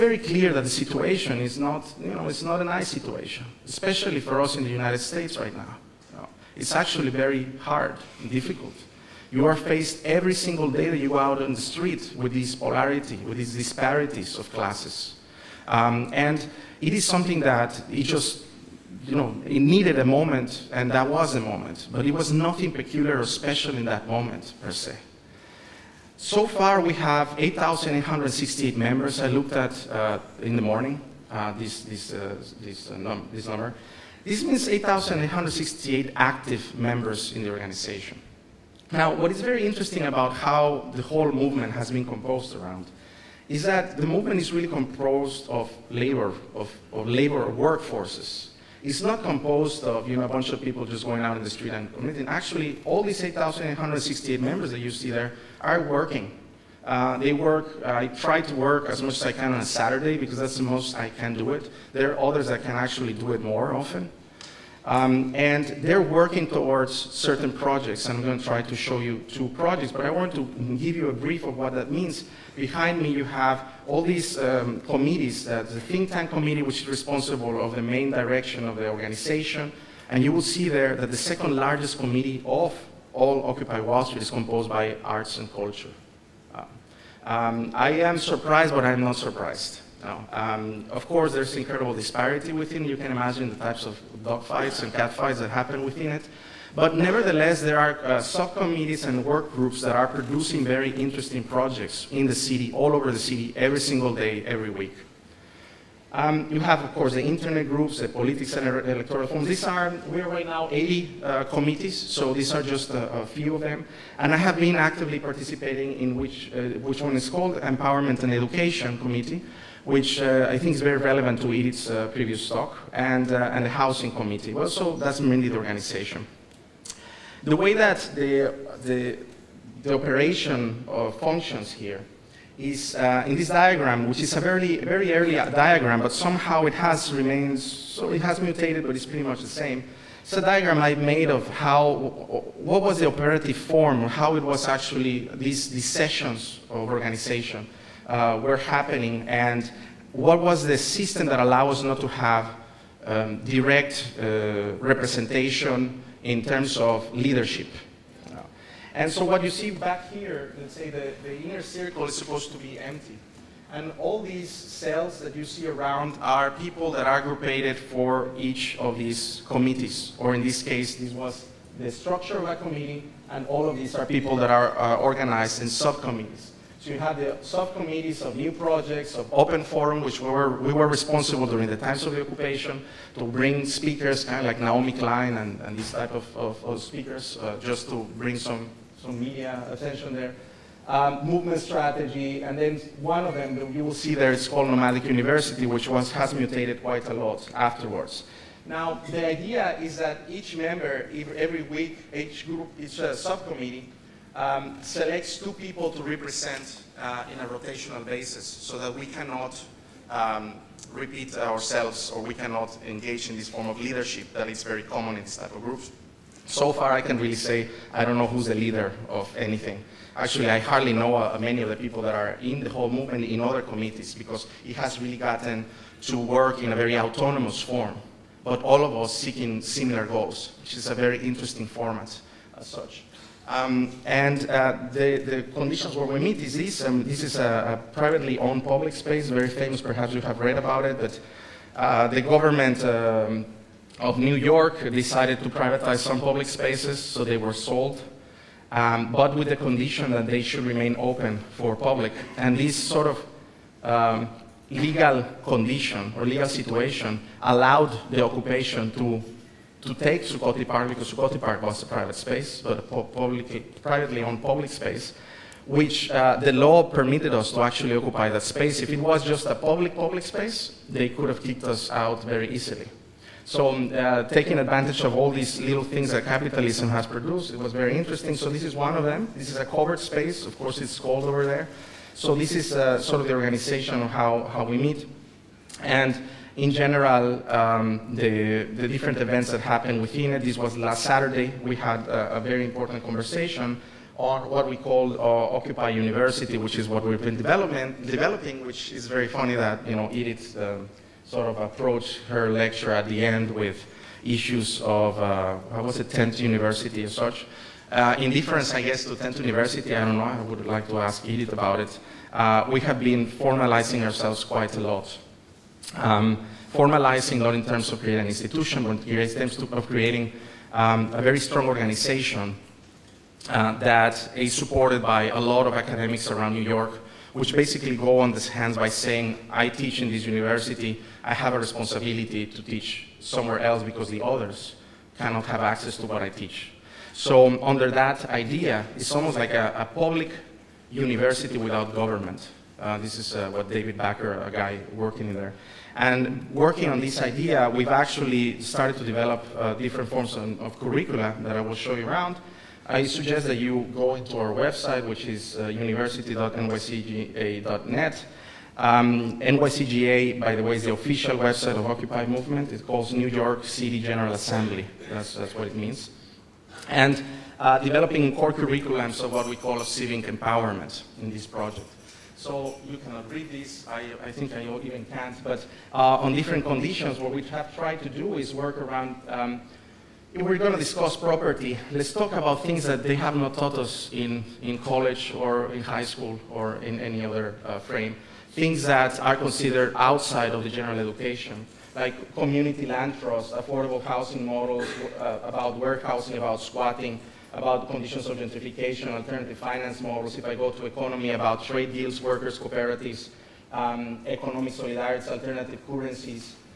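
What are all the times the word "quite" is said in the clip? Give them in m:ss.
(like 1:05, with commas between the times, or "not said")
3:16, 5:14.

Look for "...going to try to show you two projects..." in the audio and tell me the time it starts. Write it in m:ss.
1:08.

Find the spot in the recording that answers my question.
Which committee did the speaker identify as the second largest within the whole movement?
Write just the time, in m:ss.
1:25.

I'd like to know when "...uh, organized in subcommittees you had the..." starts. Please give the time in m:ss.
2:54.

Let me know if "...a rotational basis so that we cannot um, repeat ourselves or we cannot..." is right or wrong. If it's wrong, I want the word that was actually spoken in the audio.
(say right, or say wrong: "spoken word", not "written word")
right.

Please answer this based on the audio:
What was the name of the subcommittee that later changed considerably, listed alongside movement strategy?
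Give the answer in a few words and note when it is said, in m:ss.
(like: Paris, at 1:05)
Nomadic University, at 3:14.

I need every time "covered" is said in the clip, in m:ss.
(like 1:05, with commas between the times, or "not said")
4:39.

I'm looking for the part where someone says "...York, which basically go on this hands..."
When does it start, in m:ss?
5:26.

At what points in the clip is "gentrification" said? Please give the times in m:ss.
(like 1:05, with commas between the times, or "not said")
6:38.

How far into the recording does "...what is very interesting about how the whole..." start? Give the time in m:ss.
0:39.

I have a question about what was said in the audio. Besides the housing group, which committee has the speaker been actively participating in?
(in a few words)
Empowerment and Education Committee.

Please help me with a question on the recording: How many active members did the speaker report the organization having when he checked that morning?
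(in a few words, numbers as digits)
8,868.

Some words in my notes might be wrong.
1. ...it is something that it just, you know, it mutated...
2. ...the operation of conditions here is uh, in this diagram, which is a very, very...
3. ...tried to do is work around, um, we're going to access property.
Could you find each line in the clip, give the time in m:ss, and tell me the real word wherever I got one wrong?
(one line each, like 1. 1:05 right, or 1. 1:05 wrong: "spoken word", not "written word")
1. 0:16 wrong: "needed", not "mutated"
2. 2:09 wrong: "functions", not "conditions"
3. 6:17 wrong: "discuss", not "access".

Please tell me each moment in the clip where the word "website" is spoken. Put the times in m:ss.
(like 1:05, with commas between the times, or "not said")
5:54, 6:01.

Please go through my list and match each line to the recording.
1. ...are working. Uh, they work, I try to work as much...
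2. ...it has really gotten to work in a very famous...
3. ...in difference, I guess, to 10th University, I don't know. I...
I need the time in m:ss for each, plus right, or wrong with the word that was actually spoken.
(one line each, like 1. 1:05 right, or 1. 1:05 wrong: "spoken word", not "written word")
1. 0:55 right
2. 3:44 wrong: "autonomous", not "famous"
3. 5:08 right.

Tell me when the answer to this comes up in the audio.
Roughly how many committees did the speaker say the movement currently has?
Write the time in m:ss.
1:50.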